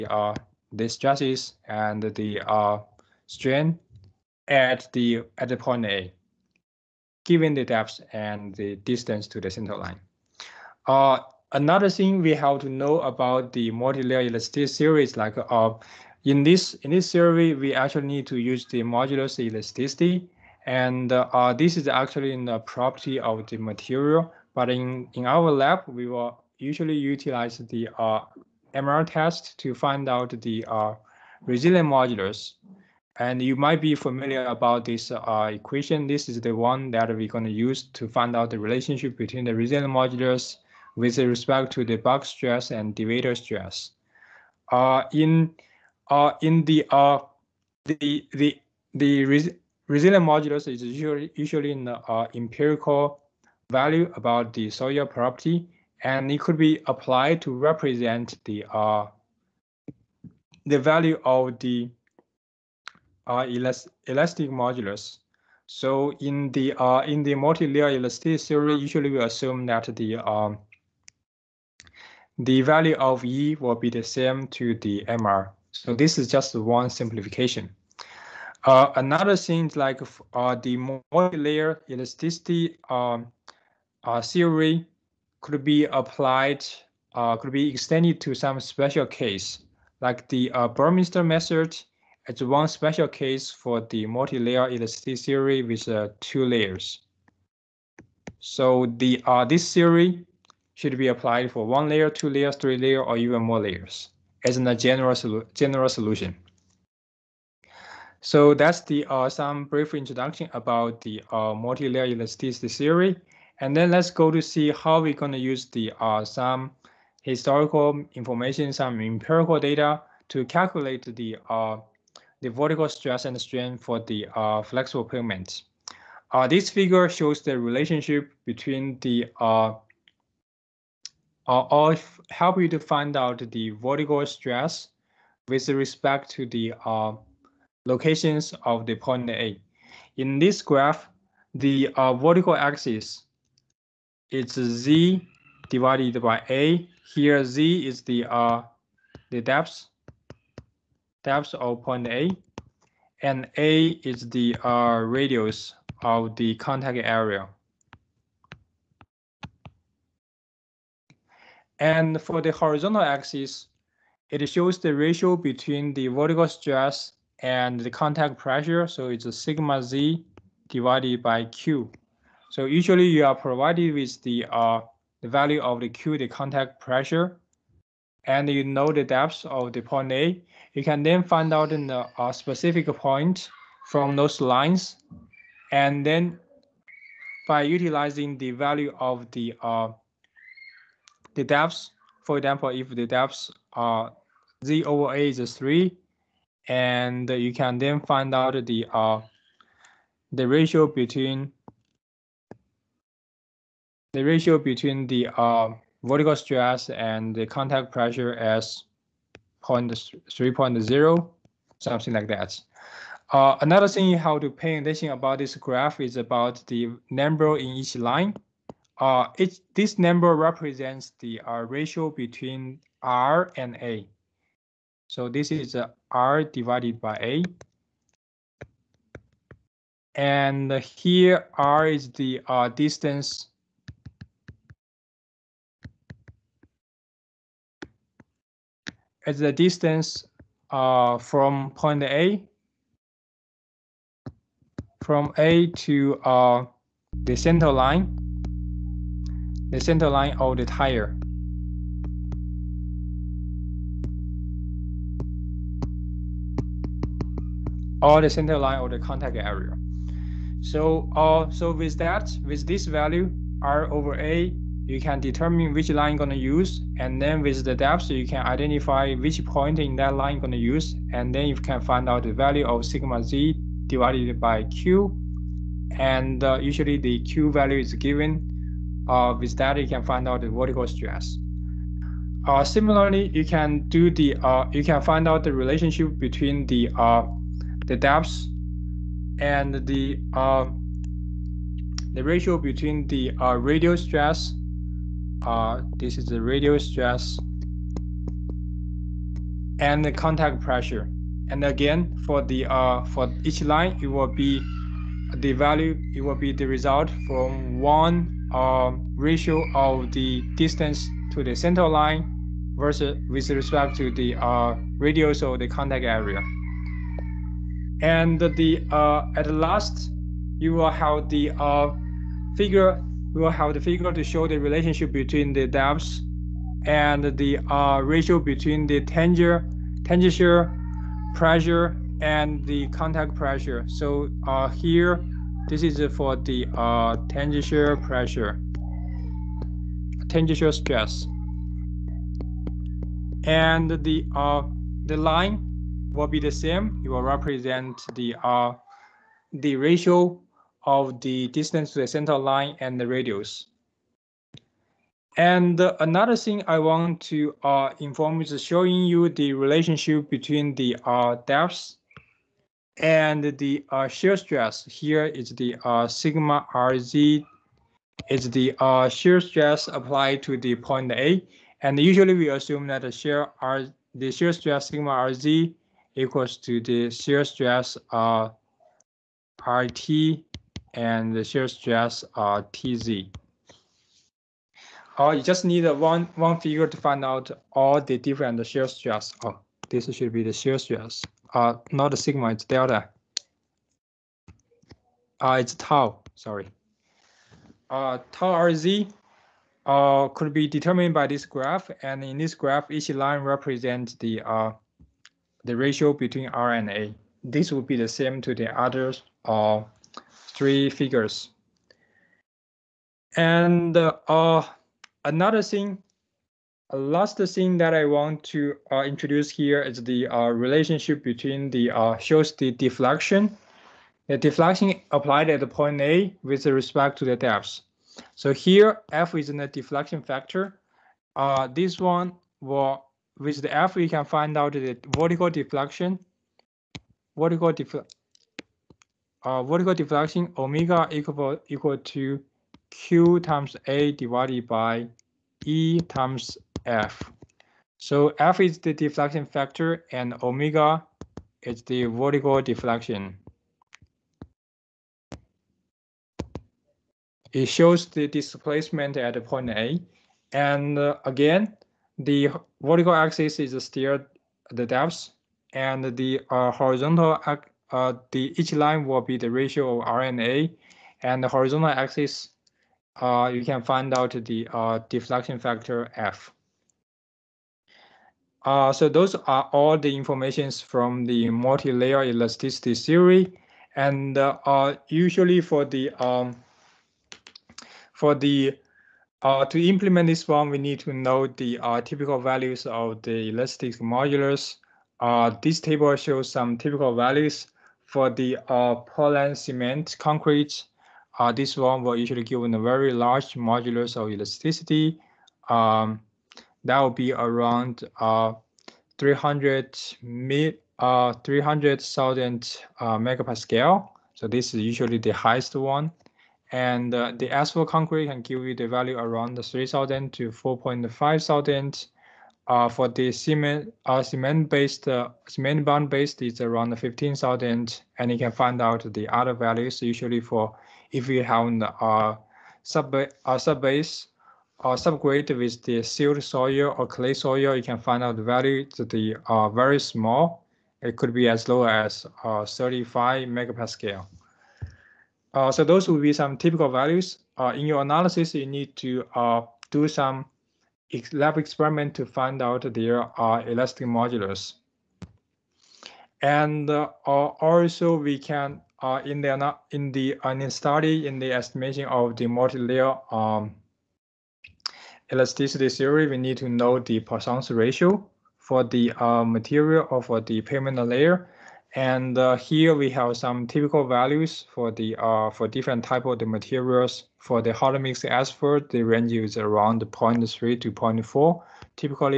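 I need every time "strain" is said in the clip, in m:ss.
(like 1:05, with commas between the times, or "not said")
0:03, 2:03.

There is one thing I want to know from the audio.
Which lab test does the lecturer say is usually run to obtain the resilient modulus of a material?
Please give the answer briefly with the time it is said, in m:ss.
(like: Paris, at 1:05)
MR test, at 0:28.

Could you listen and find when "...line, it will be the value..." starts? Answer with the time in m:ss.
5:03.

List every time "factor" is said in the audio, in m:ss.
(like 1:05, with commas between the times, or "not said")
7:10, 7:29, 7:55.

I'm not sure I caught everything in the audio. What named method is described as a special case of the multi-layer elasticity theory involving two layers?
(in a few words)
Burmister method.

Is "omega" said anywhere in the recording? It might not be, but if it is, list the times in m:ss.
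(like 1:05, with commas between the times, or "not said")
7:20, 7:30.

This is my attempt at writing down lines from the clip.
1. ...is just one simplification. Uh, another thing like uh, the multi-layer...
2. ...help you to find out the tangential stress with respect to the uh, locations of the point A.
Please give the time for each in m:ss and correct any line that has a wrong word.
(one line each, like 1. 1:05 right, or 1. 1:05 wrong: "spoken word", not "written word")
1. 1:16 right
2. 2:12 wrong: "vertical", not "tangential".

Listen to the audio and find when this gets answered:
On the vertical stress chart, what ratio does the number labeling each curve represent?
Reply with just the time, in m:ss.
3:46.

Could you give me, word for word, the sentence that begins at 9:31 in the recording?
And uh, here we have some typical values for the uh, for different type of the materials.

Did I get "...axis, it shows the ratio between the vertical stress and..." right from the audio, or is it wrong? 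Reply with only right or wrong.
right.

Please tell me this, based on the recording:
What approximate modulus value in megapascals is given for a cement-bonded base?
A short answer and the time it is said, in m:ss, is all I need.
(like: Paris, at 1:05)
15,000, at 8:46.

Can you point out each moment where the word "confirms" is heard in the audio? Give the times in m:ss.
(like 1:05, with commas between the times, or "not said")
not said.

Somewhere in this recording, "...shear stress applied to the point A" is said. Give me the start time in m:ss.
6:09.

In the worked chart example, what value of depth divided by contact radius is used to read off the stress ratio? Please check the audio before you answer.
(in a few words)
3.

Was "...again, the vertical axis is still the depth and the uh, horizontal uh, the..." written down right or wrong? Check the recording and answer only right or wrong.
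right.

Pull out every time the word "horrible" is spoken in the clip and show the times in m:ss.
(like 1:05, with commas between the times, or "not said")
not said.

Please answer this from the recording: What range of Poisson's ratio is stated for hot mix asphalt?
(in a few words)
0.3 to 0.4.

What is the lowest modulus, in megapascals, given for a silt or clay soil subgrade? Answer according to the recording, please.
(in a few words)
35.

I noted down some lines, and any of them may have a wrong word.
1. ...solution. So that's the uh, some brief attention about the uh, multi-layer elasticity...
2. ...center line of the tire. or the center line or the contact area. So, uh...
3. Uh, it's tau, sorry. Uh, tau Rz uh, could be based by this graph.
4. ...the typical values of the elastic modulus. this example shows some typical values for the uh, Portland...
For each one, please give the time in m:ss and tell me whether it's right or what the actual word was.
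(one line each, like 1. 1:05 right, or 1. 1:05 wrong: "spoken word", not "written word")
1. 1:45 wrong: "introduction", not "attention"
2. 4:09 right
3. 6:35 wrong: "determined", not "based"
4. 8:11 wrong: "table", not "example".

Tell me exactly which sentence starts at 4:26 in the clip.
And then with the depth, you can identify which point in that line you're going to use.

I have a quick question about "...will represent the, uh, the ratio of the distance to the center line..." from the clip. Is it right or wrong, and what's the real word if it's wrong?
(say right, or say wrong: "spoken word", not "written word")
right.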